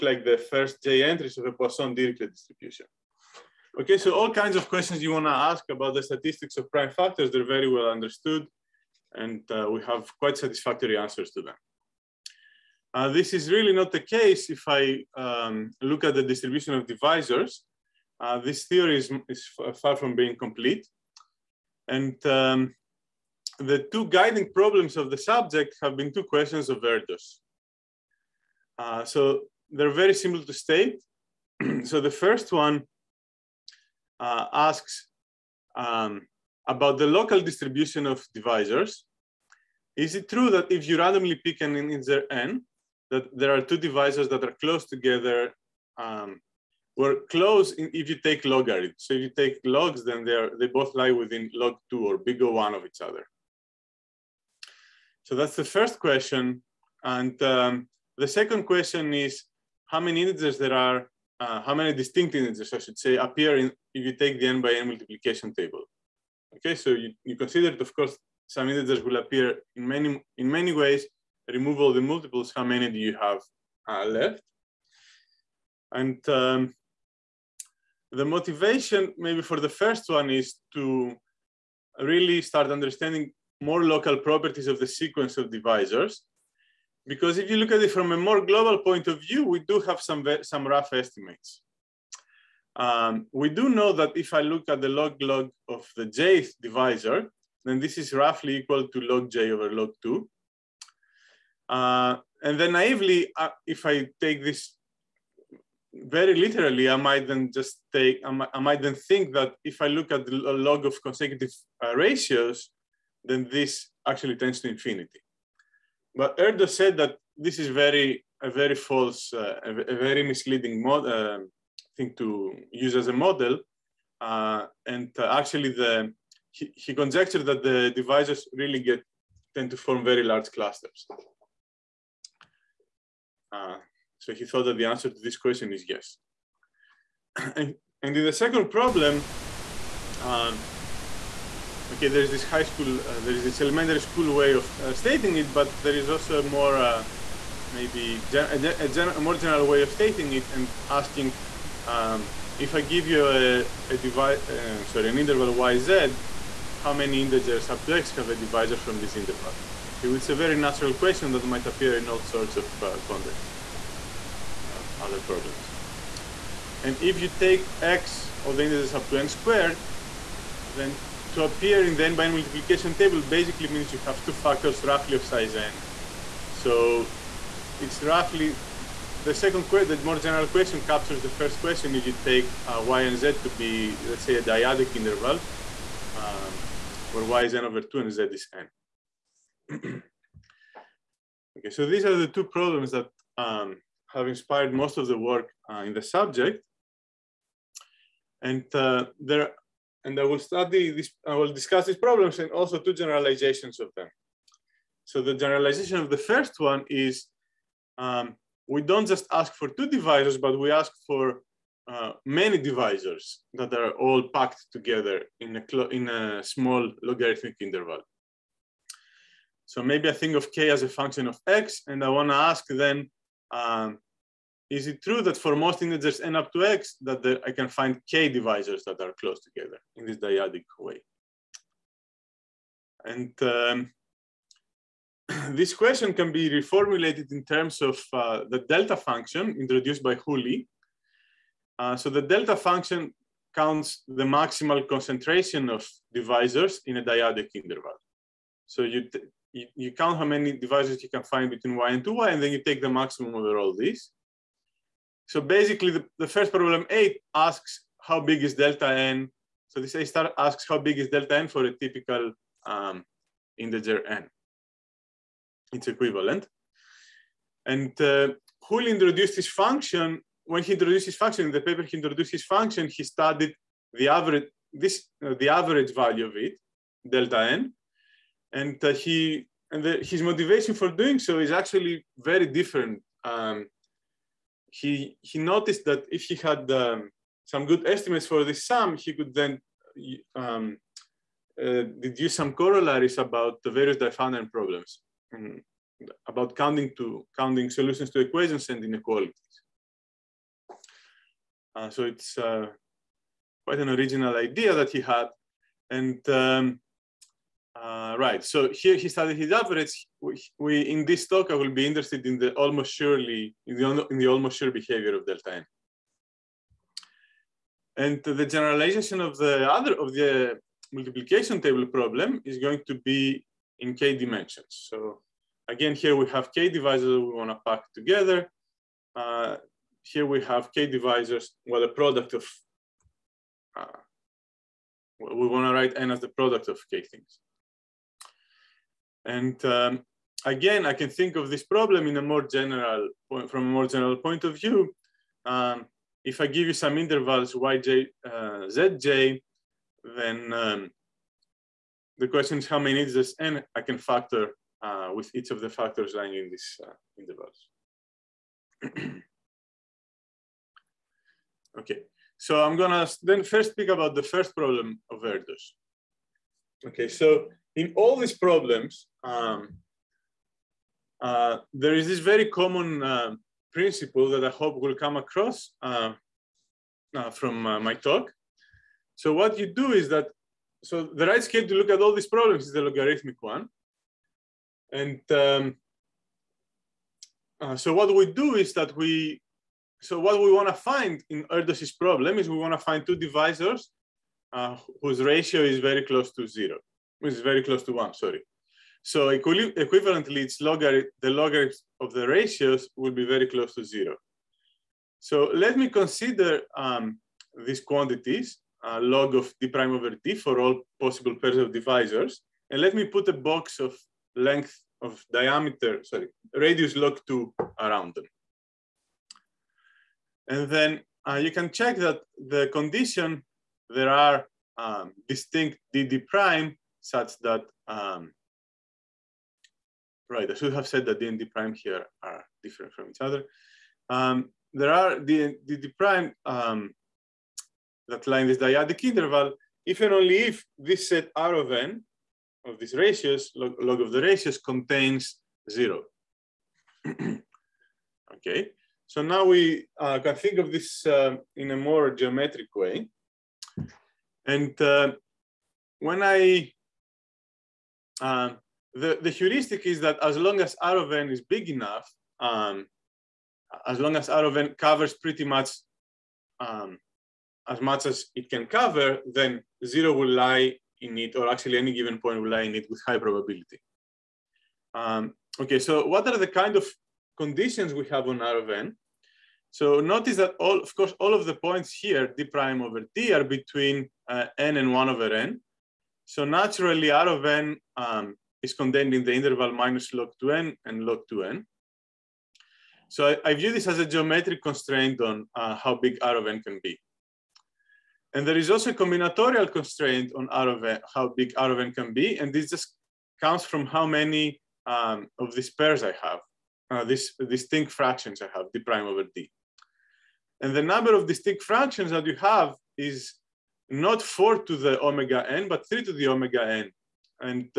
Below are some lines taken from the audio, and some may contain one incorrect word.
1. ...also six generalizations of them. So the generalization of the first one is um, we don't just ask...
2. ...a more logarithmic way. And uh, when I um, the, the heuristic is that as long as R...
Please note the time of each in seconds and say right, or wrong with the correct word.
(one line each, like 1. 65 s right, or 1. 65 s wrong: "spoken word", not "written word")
1. 202 s wrong: "two", not "six"
2. 451 s wrong: "geometric", not "logarithmic".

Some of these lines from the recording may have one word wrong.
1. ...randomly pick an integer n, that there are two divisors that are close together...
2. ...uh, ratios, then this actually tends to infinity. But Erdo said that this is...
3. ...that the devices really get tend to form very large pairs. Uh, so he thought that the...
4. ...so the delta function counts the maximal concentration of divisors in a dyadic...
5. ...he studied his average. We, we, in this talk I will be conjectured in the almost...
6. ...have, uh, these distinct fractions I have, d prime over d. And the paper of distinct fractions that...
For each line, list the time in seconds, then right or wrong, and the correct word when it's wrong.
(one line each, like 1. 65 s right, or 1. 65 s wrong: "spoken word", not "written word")
1. 40 s right
2. 111 s right
3. 127 s wrong: "clusters", not "pairs"
4. 241 s right
5. 308 s wrong: "interested", not "conjectured"
6. 506 s wrong: "number", not "paper".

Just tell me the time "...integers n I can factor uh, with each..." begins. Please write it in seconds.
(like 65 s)
353 s.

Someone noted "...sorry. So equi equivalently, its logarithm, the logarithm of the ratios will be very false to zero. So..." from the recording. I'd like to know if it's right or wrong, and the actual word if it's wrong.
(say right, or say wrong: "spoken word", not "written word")
wrong: "close", not "false".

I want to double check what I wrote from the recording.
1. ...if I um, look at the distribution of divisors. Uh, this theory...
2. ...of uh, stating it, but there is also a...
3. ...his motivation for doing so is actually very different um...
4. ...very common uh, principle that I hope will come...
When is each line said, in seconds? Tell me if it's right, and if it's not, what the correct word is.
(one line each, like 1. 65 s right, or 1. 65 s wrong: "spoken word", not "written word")
1. 14 s right
2. 144 s right
3. 280 s right
4. 372 s right.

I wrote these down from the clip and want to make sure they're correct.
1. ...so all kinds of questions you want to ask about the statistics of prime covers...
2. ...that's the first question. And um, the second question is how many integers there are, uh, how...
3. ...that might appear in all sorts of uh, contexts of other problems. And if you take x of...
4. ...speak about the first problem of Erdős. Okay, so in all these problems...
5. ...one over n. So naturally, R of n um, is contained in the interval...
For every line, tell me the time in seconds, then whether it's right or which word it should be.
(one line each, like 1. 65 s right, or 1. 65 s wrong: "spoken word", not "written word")
1. 3 s wrong: "factors", not "covers"
2. 55 s right
3. 161 s right
4. 363 s right
5. 484 s right.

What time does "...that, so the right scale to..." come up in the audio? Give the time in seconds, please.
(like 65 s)
380 s.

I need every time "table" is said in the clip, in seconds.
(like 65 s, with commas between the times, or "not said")
65 s, 172 s, 321 s.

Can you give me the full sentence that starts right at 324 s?
So again, here we have k divisors we want to pack together.